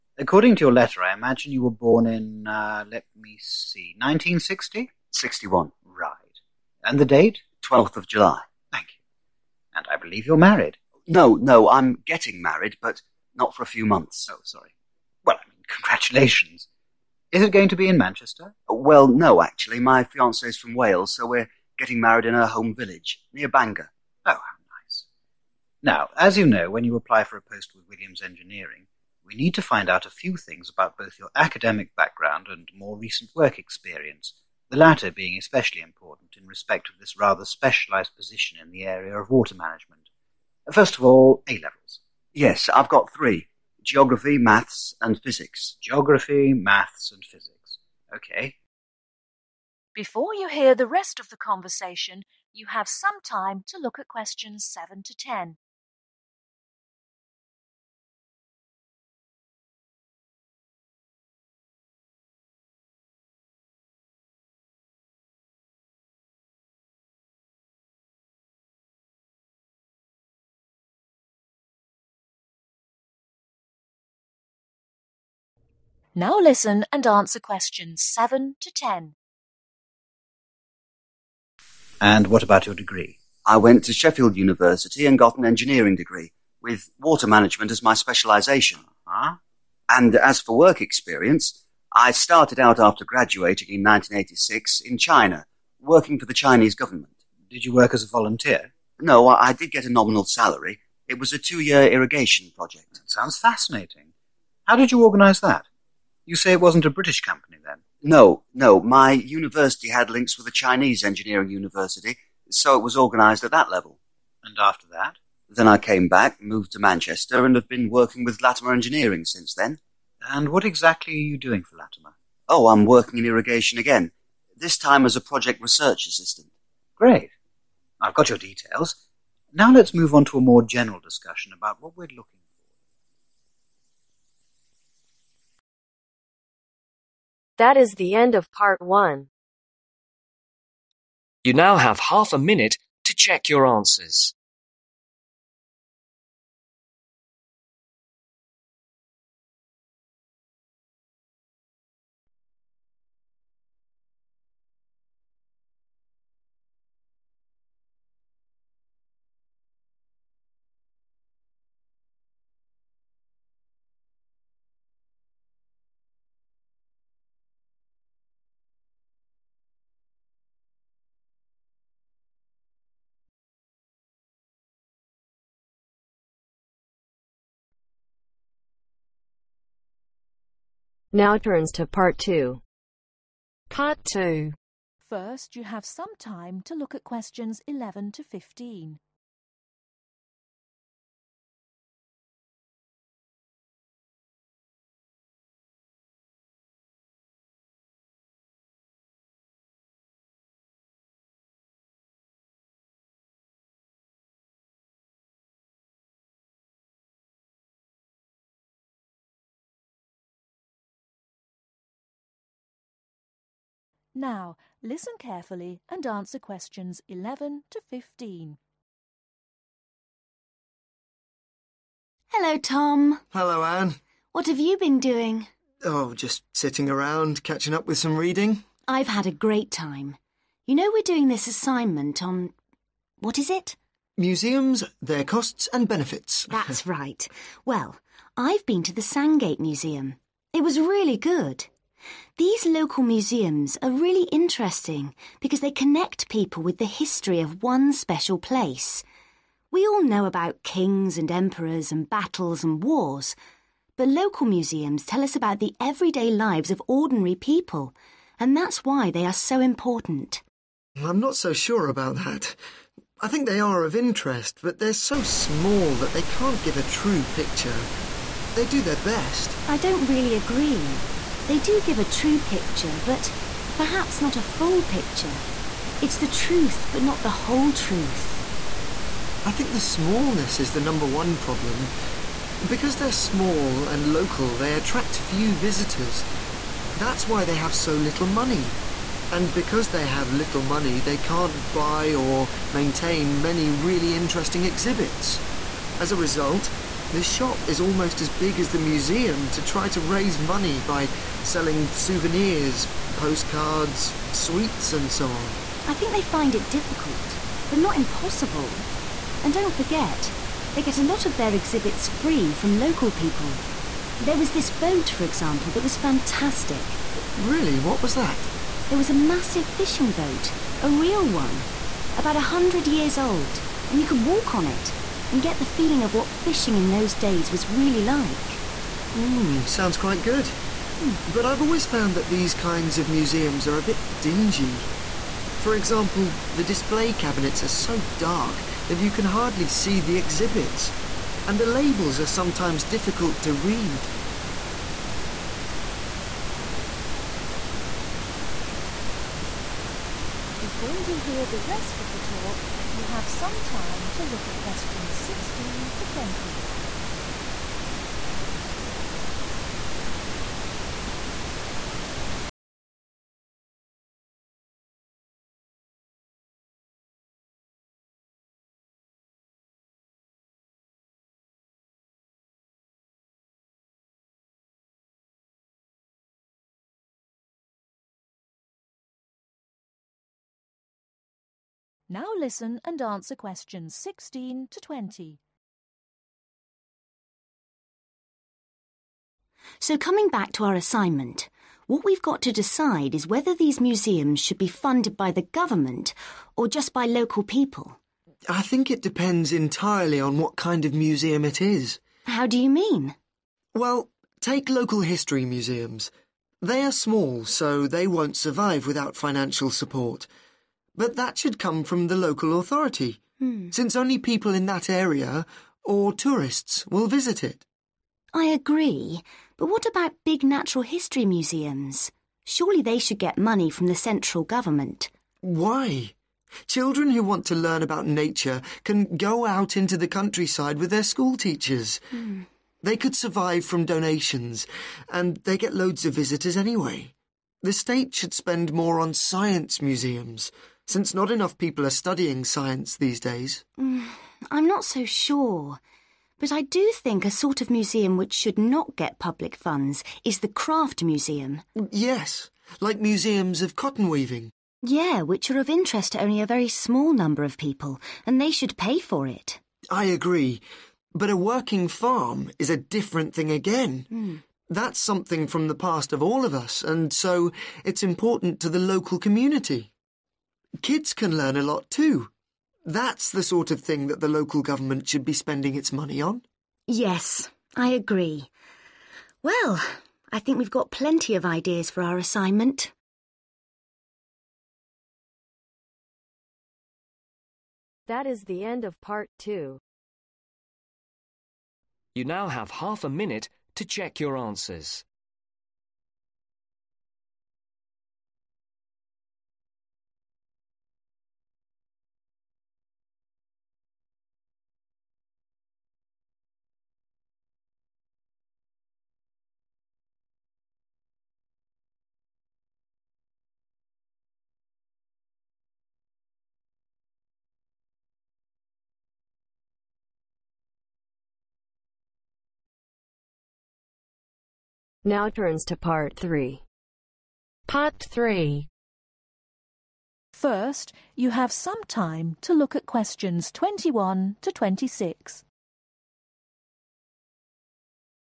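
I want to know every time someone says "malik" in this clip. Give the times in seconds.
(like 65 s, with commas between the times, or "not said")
not said.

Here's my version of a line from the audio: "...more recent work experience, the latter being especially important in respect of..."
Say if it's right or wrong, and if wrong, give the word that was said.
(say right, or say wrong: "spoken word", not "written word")
right.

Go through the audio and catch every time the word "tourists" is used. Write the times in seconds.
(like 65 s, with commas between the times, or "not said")
416 s.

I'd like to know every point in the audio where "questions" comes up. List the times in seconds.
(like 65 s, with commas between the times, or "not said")
54 s, 77 s, 187 s, 216 s, 354 s, 383 s, 532 s.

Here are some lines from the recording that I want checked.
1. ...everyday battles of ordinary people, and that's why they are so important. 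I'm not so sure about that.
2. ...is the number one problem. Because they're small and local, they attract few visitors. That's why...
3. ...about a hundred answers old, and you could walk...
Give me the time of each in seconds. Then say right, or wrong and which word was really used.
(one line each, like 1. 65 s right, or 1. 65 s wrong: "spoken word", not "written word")
1. 255 s wrong: "lives", not "battles"
2. 280 s right
3. 322 s wrong: "years", not "answers".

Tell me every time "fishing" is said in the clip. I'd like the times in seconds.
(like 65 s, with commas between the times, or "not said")
319 s, 326 s.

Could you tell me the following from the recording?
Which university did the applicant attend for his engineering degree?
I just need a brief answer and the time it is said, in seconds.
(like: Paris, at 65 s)
Sheffield University, at 83 s.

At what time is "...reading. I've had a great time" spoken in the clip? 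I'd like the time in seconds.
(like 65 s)
228 s.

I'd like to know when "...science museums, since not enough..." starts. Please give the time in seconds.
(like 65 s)
439 s.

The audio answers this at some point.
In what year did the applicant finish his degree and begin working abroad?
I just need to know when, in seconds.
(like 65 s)
93 s.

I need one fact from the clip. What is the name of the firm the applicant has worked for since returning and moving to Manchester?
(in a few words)
Latimer Engineering.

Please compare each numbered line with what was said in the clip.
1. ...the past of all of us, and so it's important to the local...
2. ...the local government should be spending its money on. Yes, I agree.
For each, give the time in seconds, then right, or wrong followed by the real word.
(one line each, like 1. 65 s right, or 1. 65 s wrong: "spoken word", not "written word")
1. 465 s right
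2. 474 s right.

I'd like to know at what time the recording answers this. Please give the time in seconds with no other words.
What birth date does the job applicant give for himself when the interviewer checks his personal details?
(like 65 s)
7 s.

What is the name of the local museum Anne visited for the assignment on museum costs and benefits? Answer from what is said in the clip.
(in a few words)
Sandgate Museum.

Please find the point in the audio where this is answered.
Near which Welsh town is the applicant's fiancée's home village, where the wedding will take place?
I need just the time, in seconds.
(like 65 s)
23 s.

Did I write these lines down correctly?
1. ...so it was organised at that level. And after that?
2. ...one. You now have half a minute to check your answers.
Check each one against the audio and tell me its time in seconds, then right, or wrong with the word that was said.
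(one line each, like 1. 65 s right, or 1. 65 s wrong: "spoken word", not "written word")
1. 112 s right
2. 138 s right.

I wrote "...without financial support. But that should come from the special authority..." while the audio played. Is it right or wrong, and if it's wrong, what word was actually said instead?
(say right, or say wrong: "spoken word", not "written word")
wrong: "local", not "special".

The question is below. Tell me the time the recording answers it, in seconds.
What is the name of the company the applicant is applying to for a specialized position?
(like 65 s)
27 s.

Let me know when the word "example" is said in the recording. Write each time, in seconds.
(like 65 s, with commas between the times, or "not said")
315 s, 335 s.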